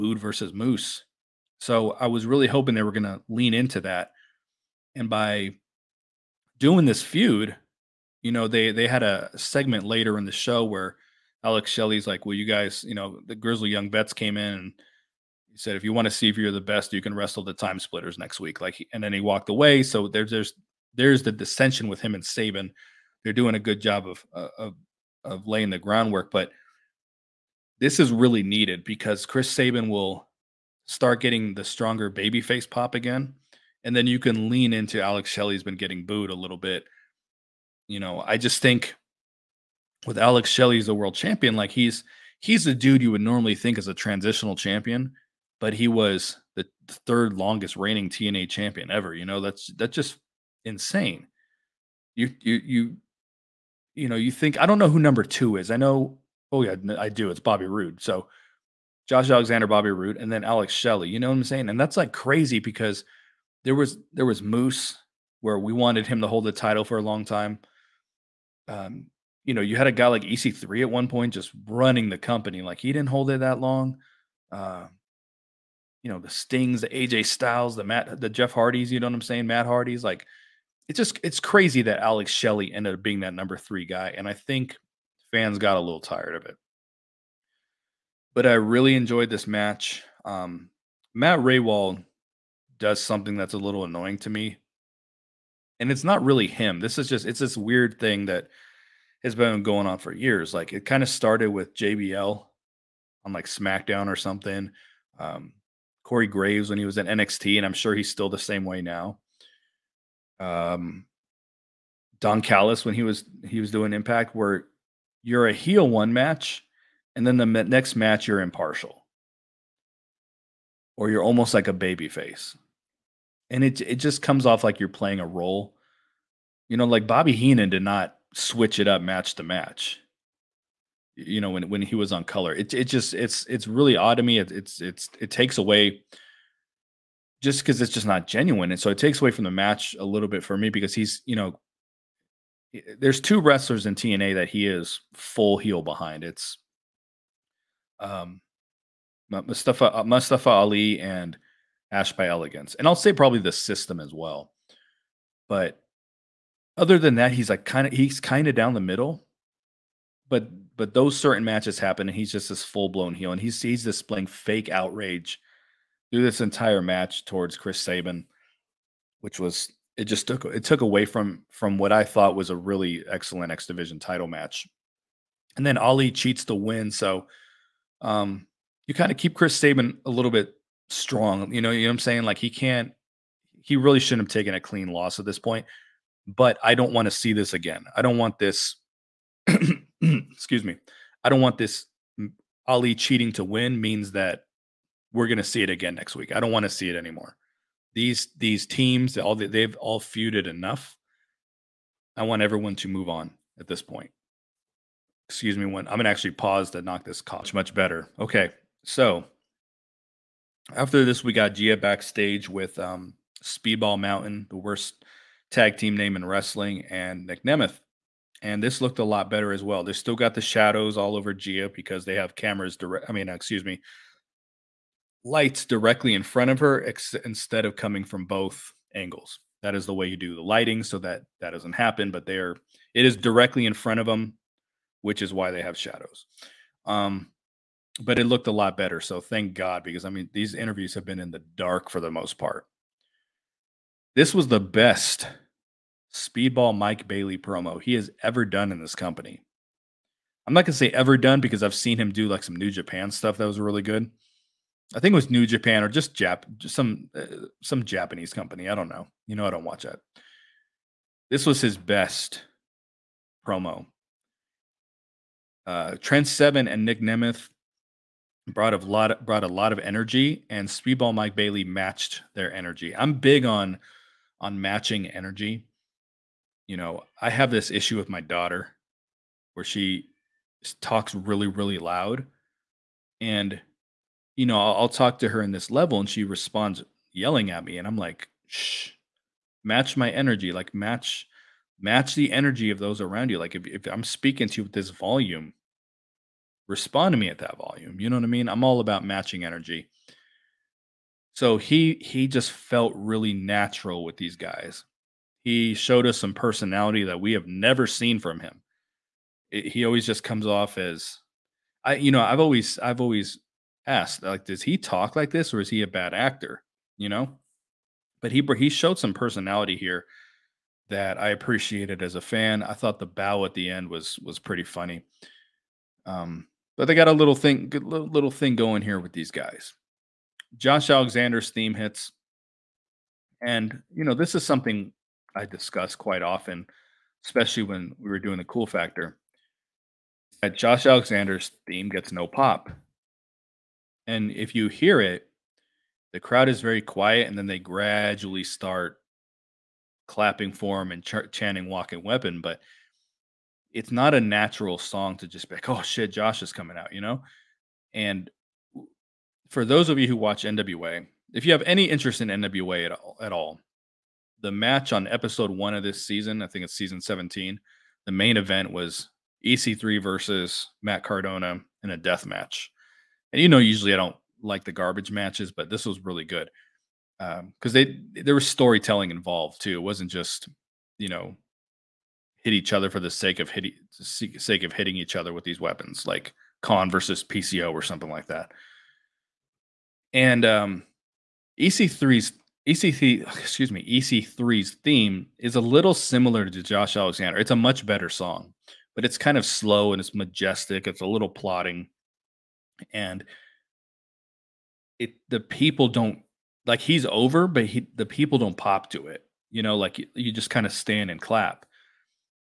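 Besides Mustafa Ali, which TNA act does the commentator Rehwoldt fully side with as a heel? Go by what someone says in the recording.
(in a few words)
Ash by Elegance.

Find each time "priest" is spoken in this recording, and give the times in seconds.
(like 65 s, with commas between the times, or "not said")
not said.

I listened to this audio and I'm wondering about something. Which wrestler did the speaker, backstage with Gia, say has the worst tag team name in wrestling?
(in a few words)
Speedball Mountain.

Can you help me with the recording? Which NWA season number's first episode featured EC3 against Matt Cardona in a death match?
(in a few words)
17.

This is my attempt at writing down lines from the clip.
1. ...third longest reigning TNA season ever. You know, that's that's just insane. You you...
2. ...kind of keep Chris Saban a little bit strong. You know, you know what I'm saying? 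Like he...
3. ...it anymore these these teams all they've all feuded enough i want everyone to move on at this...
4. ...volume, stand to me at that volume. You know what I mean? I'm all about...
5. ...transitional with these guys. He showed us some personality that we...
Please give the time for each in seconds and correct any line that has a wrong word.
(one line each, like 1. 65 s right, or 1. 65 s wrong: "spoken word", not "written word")
1. 47 s wrong: "champion", not "season"
2. 178 s right
3. 196 s right
4. 294 s wrong: "respond", not "stand"
5. 303 s wrong: "natural", not "transitional".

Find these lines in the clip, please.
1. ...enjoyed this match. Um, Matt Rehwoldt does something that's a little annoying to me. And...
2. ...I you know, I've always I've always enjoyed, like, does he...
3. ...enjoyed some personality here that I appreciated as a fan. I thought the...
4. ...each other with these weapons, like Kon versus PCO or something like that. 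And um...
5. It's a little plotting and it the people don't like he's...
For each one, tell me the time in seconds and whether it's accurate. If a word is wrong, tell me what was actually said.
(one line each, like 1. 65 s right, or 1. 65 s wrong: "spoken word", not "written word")
1. 88 s right
2. 311 s wrong: "asked", not "enjoyed"
3. 318 s wrong: "showed", not "enjoyed"
4. 384 s right
5. 400 s right.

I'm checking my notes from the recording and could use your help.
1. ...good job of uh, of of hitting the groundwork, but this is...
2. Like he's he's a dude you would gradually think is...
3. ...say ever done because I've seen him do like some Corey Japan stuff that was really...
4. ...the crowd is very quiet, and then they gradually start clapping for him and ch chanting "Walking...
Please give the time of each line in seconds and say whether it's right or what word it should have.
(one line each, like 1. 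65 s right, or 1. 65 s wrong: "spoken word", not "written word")
1. 23 s wrong: "laying", not "hitting"
2. 41 s wrong: "normally", not "gradually"
3. 250 s wrong: "New", not "Corey"
4. 346 s right.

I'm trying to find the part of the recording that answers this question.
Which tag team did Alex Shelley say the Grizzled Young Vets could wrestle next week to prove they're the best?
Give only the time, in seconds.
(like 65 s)
17 s.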